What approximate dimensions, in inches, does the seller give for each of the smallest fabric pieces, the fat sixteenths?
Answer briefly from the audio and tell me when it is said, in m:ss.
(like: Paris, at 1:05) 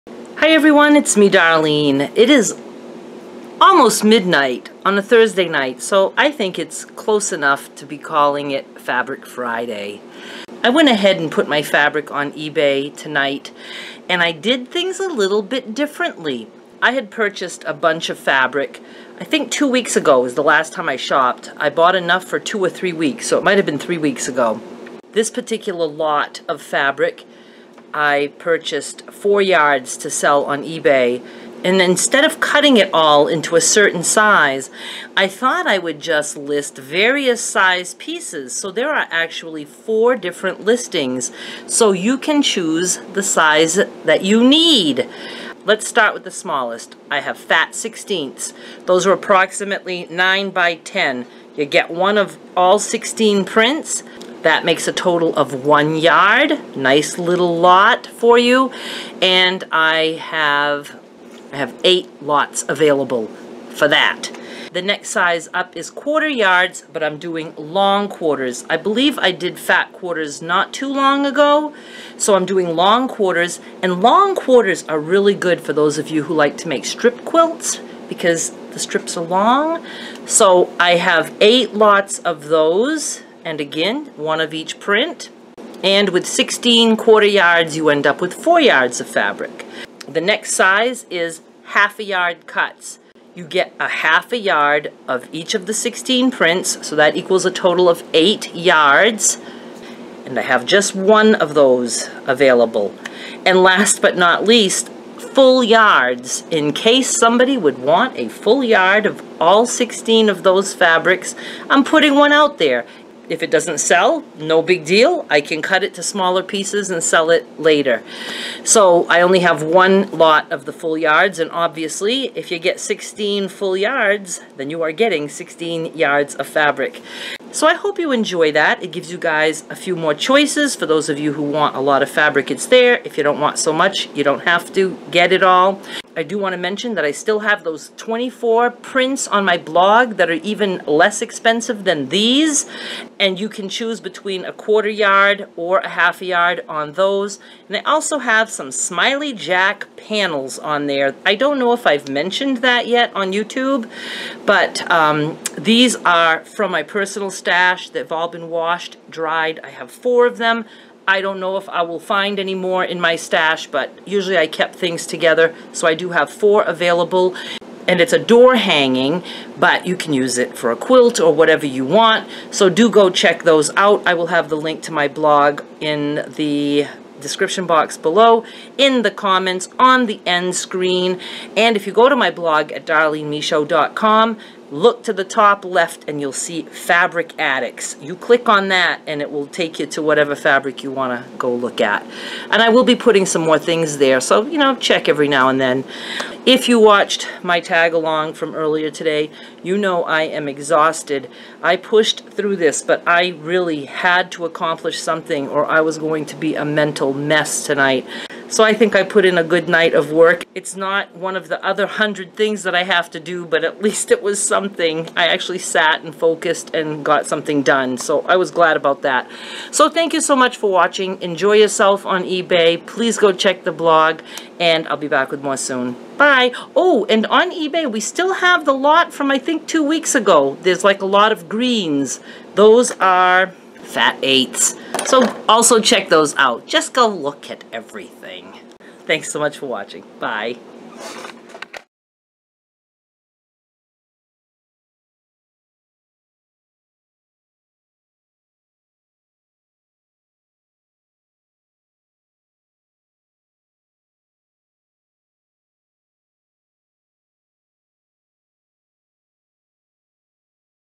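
9 by 10, at 0:50.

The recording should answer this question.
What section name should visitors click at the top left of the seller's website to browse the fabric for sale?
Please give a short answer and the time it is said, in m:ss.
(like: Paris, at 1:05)
Fabric Addicts, at 3:06.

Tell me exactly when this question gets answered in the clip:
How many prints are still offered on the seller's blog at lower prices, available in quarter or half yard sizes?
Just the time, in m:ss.
2:17.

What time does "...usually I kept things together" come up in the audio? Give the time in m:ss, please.
2:44.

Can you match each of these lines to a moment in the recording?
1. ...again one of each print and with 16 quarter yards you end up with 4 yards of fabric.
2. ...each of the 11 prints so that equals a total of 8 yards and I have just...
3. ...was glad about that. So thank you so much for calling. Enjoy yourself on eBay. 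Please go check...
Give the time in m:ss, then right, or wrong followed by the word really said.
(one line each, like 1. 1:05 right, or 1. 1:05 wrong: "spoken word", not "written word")
1. 1:23 right
2. 1:35 wrong: "16", not "11"
3. 3:38 wrong: "watching", not "calling".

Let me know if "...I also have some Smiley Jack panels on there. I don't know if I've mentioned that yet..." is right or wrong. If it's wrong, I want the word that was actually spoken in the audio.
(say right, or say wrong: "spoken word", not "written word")
right.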